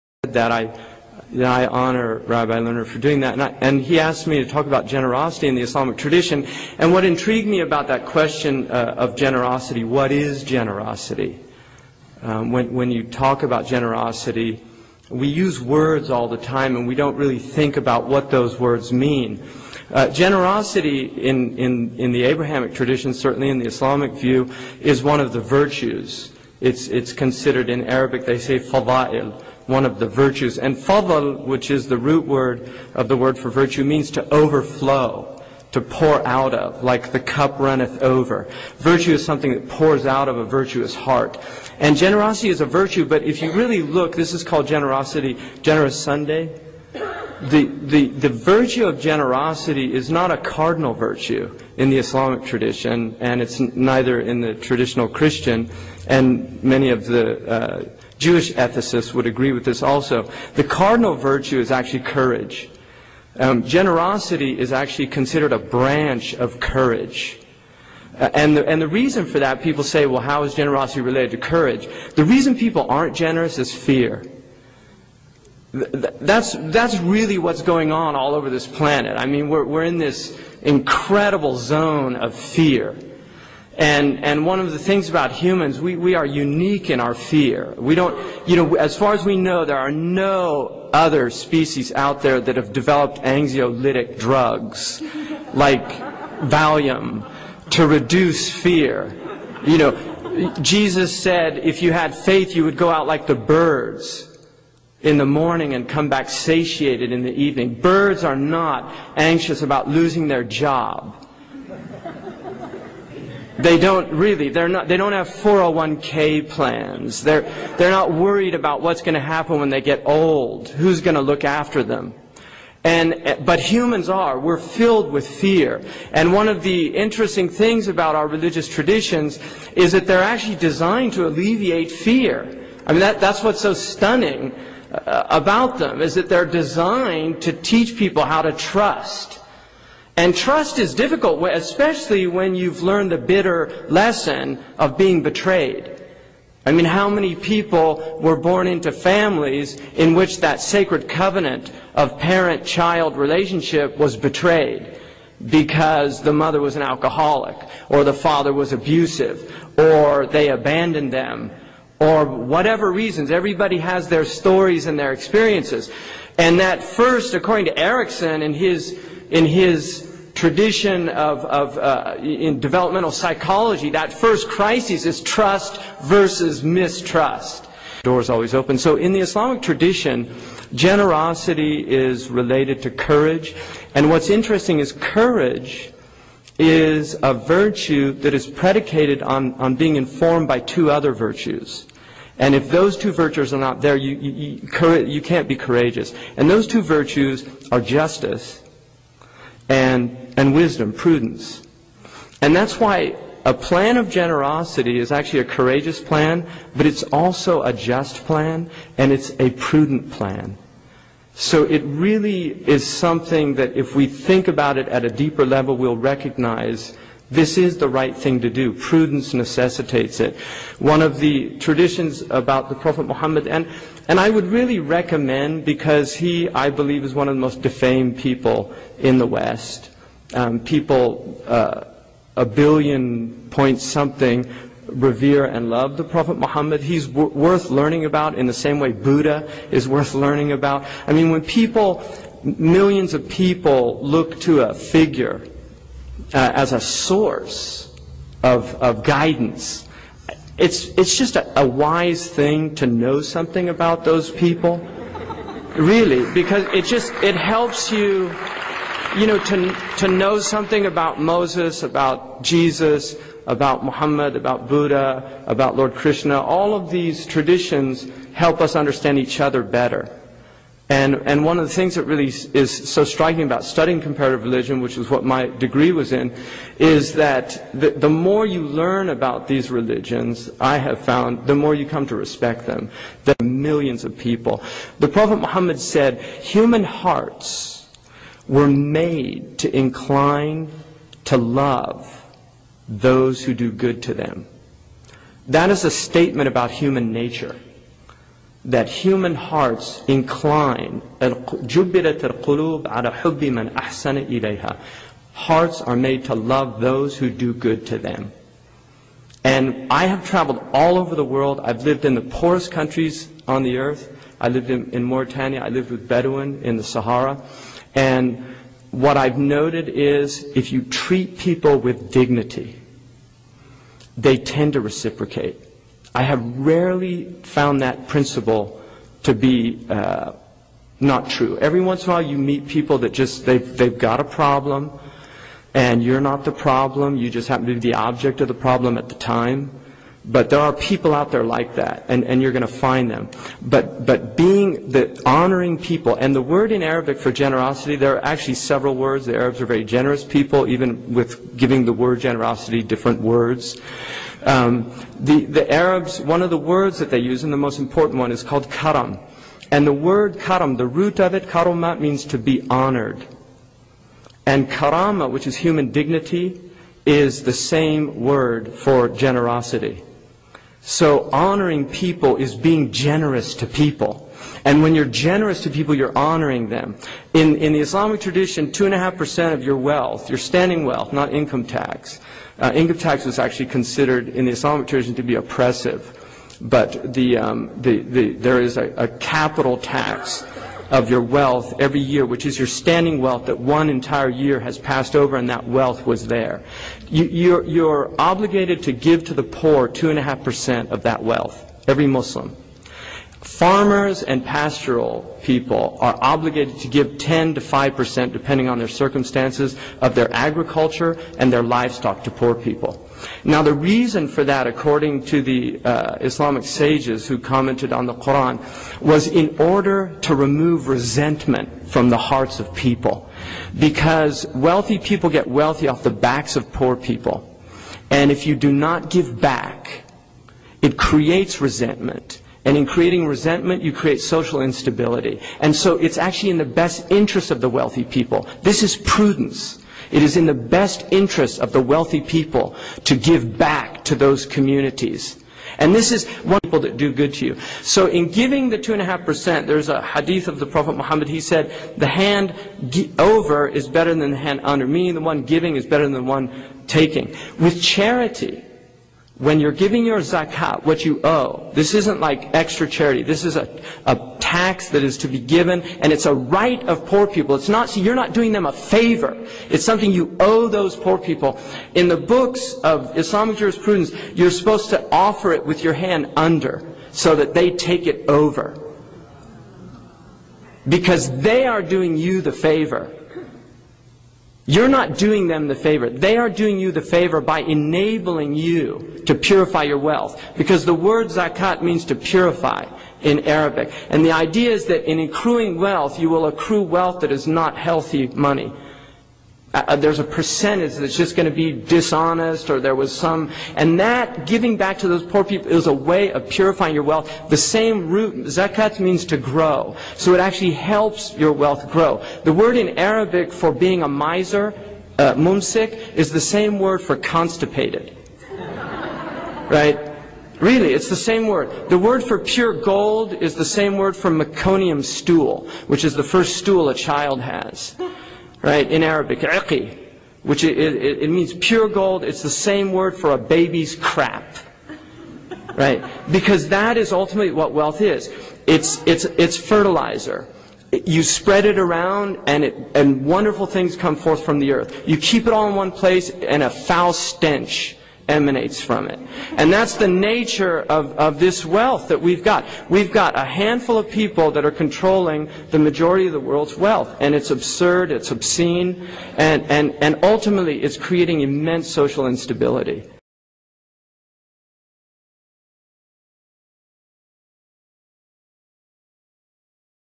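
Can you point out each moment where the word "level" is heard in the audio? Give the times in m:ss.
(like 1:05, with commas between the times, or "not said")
3:35.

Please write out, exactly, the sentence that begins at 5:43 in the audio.
But, but being the honoring people, and the word in Arabic for generosity, there are actually several words.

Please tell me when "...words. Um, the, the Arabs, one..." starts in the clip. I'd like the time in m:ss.
5:53.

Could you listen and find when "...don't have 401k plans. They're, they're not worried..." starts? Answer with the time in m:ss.
1:54.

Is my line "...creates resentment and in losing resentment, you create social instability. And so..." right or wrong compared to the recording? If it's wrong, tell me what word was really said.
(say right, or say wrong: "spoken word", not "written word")
wrong: "creating", not "losing".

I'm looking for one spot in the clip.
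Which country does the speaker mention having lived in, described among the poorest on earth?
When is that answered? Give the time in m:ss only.
5:15.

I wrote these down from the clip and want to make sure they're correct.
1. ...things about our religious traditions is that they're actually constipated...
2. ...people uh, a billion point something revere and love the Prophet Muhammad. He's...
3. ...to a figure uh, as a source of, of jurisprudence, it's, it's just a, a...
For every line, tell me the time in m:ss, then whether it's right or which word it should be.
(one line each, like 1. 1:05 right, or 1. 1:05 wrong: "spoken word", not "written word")
1. 2:07 wrong: "designed", not "constipated"
2. 3:50 right
3. 4:04 wrong: "guidance", not "jurisprudence".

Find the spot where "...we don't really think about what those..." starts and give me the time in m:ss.
0:16.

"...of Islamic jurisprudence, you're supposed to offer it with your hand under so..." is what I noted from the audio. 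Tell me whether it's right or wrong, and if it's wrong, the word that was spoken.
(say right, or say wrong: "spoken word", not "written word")
right.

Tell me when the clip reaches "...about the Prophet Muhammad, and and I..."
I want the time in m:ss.
3:42.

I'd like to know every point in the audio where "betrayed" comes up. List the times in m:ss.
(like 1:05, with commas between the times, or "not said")
2:25, 2:34.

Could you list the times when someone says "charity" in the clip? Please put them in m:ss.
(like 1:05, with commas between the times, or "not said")
7:37, 7:42.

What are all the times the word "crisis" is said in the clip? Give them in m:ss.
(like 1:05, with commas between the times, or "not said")
2:54.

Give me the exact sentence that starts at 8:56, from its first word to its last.
Because that is ultimately what wealth is.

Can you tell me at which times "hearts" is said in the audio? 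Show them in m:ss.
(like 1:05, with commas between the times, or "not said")
0:40, 4:46, 4:59, 5:05, 7:02.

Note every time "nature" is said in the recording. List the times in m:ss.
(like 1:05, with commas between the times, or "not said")
4:57, 9:10.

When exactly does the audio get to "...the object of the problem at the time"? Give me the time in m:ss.
5:37.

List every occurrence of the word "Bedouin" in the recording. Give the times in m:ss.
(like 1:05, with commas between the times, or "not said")
5:16.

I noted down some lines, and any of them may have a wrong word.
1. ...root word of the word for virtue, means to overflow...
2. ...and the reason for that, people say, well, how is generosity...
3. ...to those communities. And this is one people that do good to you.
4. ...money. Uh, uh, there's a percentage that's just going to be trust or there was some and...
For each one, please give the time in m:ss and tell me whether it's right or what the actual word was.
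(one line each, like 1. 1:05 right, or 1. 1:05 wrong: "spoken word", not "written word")
1. 0:31 right
2. 1:08 right
3. 7:24 right
4. 8:18 wrong: "dishonest", not "trust".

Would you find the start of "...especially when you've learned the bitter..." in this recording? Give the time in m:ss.
2:21.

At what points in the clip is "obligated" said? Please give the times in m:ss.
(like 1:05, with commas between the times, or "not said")
6:38, 6:46.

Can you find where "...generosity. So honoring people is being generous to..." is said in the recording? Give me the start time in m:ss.
6:09.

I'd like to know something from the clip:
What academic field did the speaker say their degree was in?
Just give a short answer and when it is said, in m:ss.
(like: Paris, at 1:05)
Comparative religion, at 4:34.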